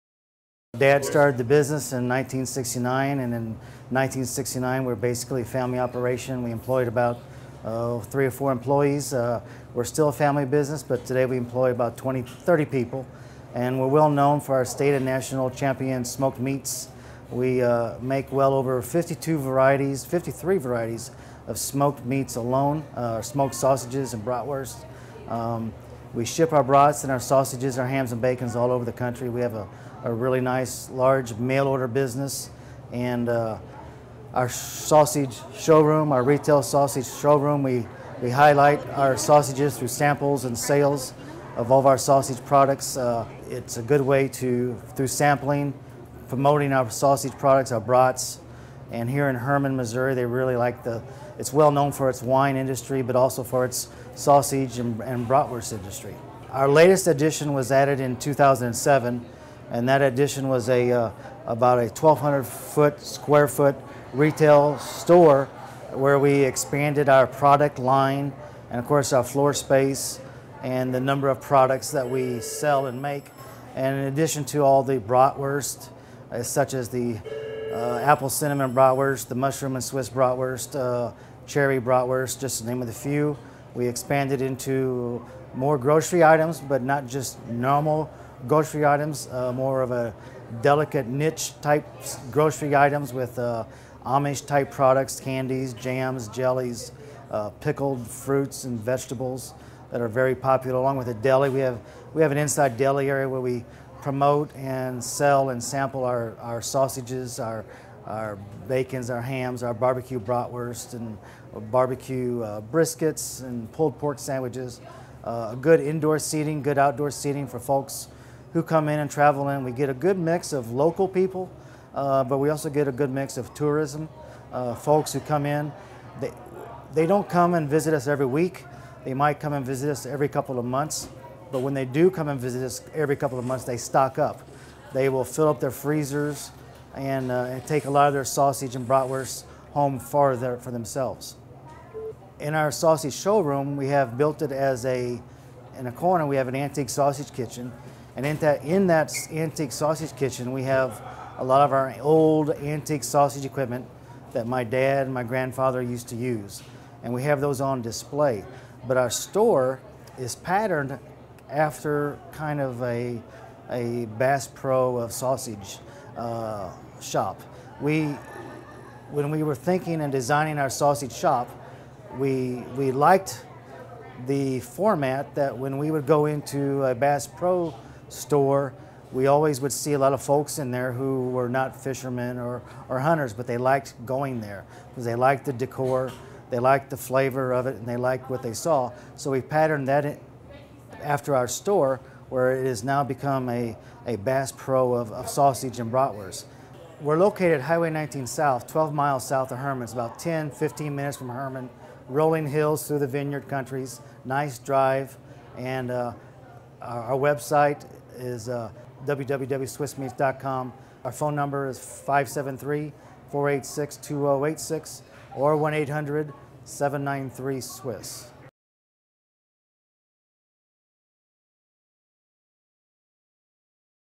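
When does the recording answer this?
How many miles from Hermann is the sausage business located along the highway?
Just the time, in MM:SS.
03:18.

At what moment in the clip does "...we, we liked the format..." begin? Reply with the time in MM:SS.
02:52.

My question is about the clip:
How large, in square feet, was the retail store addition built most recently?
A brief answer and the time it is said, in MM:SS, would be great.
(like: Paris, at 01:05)
1,200 square feet, at 01:01.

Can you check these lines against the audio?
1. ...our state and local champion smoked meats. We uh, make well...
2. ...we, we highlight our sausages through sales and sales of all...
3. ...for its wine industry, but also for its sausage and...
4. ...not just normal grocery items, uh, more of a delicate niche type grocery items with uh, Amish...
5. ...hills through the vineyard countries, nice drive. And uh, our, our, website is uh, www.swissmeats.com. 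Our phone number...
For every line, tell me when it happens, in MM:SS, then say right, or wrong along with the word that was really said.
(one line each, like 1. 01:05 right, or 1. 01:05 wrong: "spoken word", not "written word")
1. 00:14 wrong: "national", not "local"
2. 00:37 wrong: "samples", not "sales"
3. 00:51 right
4. 01:26 right
5. 03:22 right.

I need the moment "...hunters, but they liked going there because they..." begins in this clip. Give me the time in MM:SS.
03:02.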